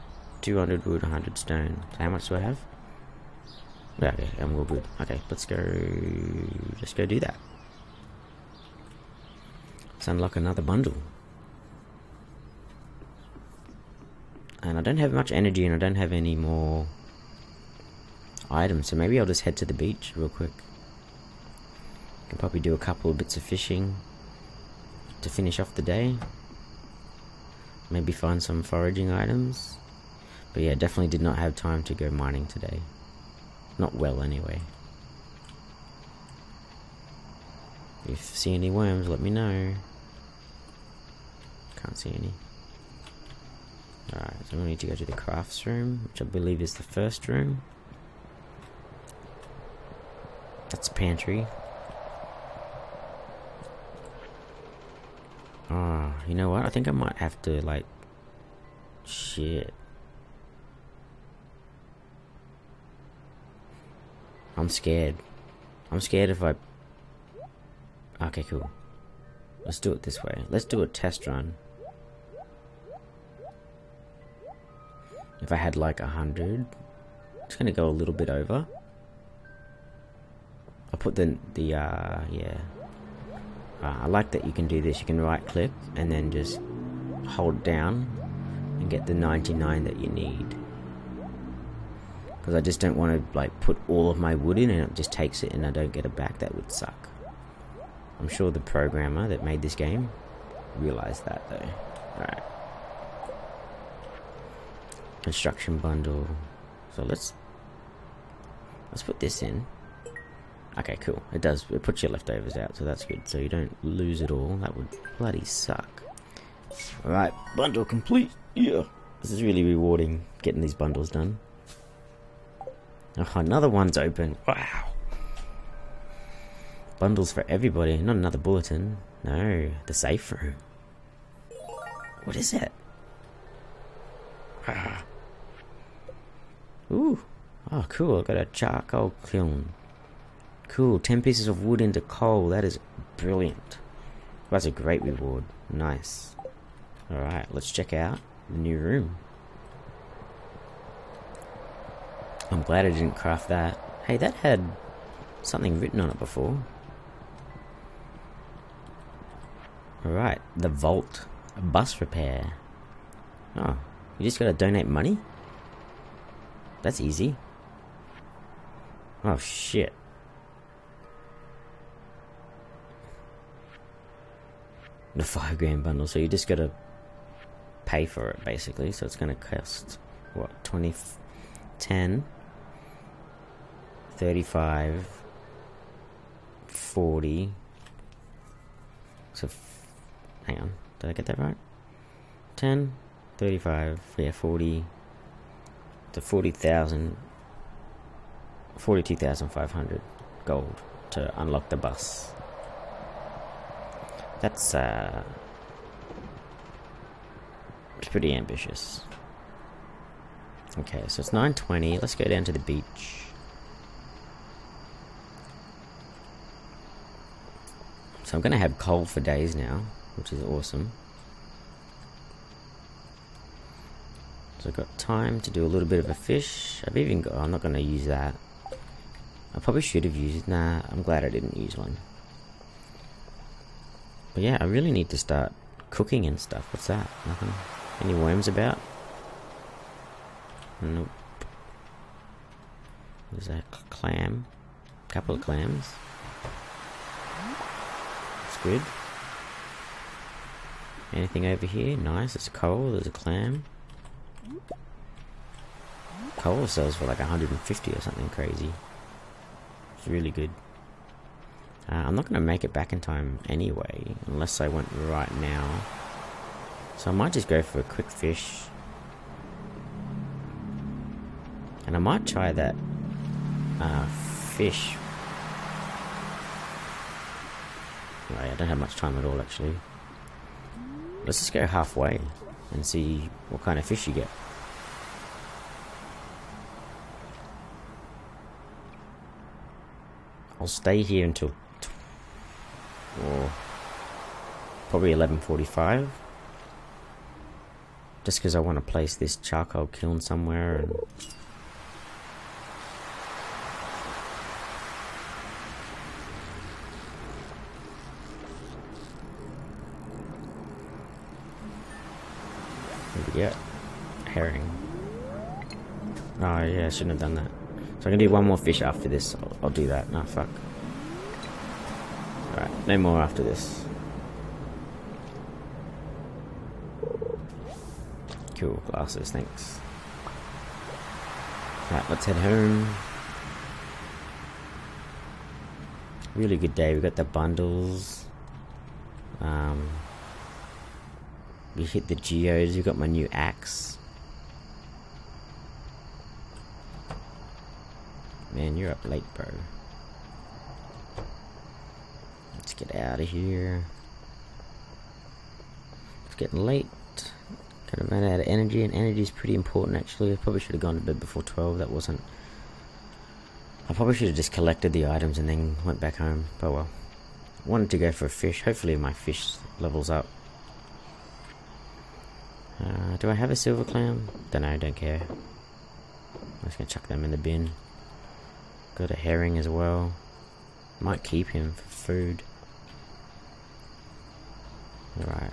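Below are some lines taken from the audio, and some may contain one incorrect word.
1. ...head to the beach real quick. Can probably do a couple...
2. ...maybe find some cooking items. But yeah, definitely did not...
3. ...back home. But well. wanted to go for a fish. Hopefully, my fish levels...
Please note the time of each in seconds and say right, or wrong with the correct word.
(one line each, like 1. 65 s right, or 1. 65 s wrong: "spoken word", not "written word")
1. 19 s right
2. 27 s wrong: "foraging", not "cooking"
3. 365 s right.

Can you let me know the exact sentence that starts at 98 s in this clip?
I'm sure the programmer that made this game realized that though.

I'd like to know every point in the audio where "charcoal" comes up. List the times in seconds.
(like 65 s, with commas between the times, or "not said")
138 s, 299 s.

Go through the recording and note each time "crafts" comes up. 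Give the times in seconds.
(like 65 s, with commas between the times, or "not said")
45 s, 153 s.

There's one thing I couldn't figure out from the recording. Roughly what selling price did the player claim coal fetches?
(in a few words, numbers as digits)
150.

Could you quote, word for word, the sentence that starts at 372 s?
Uh, do I have a silver clam?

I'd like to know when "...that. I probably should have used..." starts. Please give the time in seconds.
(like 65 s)
228 s.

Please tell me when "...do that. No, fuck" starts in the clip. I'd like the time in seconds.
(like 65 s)
319 s.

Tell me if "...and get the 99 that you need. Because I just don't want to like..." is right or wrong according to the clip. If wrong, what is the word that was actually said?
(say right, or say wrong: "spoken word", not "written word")
right.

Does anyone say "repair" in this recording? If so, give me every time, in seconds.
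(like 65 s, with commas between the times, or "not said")
162 s.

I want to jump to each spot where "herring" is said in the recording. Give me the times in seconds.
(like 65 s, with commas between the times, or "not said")
314 s, 379 s.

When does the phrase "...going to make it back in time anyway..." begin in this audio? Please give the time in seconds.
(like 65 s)
262 s.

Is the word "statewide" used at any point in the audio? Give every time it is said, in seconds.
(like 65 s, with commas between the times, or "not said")
not said.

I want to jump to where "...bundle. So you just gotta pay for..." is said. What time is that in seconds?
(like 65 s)
175 s.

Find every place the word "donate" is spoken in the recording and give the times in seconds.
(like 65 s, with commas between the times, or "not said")
164 s.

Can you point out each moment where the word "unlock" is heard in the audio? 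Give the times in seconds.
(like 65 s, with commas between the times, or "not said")
10 s, 201 s.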